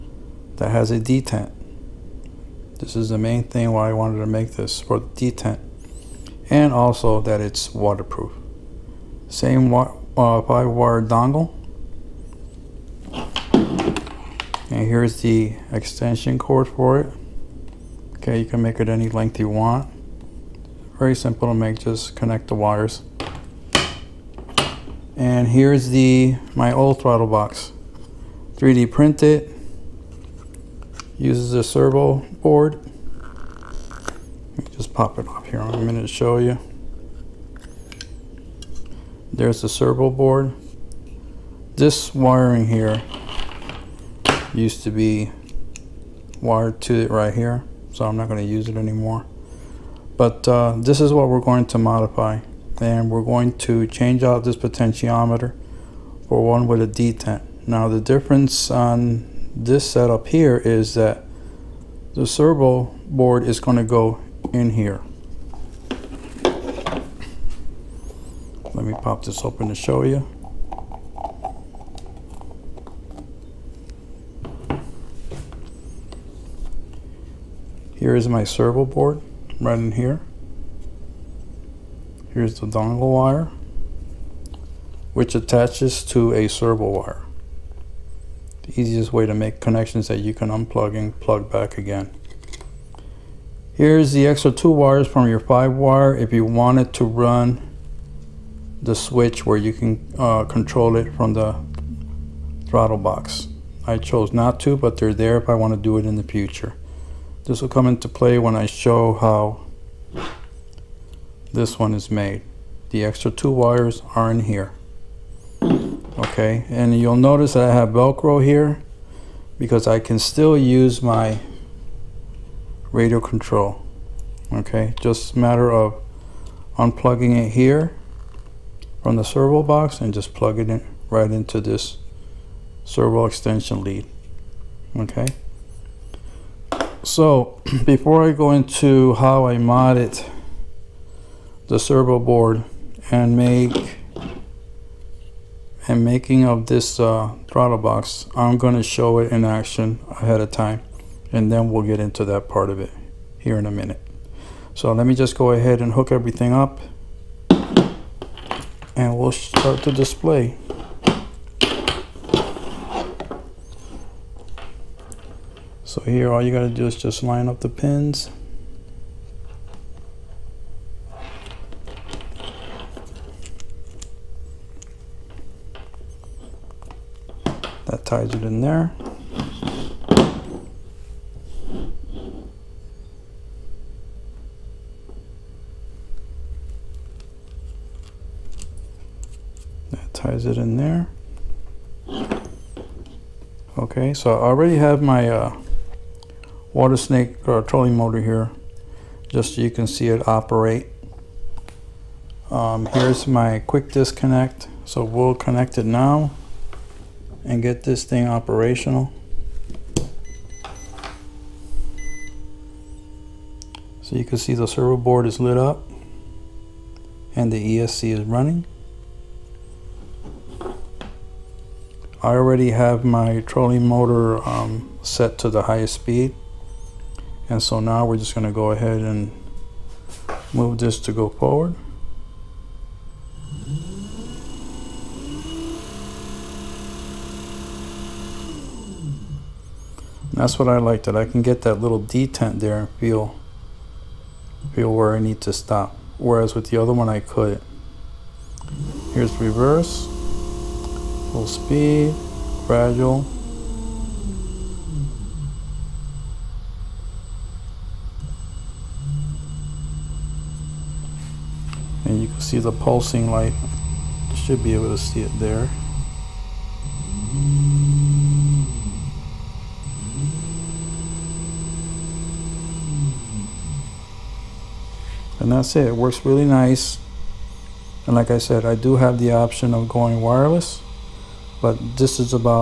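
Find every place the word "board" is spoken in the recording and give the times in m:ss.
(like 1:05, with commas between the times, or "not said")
0:32, 0:40, 1:03, 1:18, 2:22, 3:34.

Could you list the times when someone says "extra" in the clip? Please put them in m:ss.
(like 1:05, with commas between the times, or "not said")
1:34, 1:53.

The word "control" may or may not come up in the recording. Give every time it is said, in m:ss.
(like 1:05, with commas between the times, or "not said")
1:40, 2:03.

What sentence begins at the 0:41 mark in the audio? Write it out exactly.
This wiring here used to be wired to it right here, so I'm not going to use it anymore.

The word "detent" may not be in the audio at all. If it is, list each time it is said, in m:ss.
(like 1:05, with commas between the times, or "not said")
0:00, 0:05, 0:56, 4:02.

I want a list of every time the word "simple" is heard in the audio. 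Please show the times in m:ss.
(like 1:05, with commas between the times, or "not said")
0:21.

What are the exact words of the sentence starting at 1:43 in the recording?
I chose not to, but they're there if I want to do it in the future.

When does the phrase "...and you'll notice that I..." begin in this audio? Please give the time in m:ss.
1:56.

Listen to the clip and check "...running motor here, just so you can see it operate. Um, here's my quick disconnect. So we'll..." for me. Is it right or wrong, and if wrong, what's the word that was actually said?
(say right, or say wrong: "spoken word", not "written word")
wrong: "trolling", not "running".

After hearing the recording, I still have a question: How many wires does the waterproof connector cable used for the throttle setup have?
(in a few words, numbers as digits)
5.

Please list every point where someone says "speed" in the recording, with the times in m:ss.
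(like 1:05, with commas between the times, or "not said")
3:45, 4:11.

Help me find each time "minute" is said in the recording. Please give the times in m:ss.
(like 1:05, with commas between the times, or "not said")
0:35, 2:33.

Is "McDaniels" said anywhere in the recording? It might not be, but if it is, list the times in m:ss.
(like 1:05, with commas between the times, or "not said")
not said.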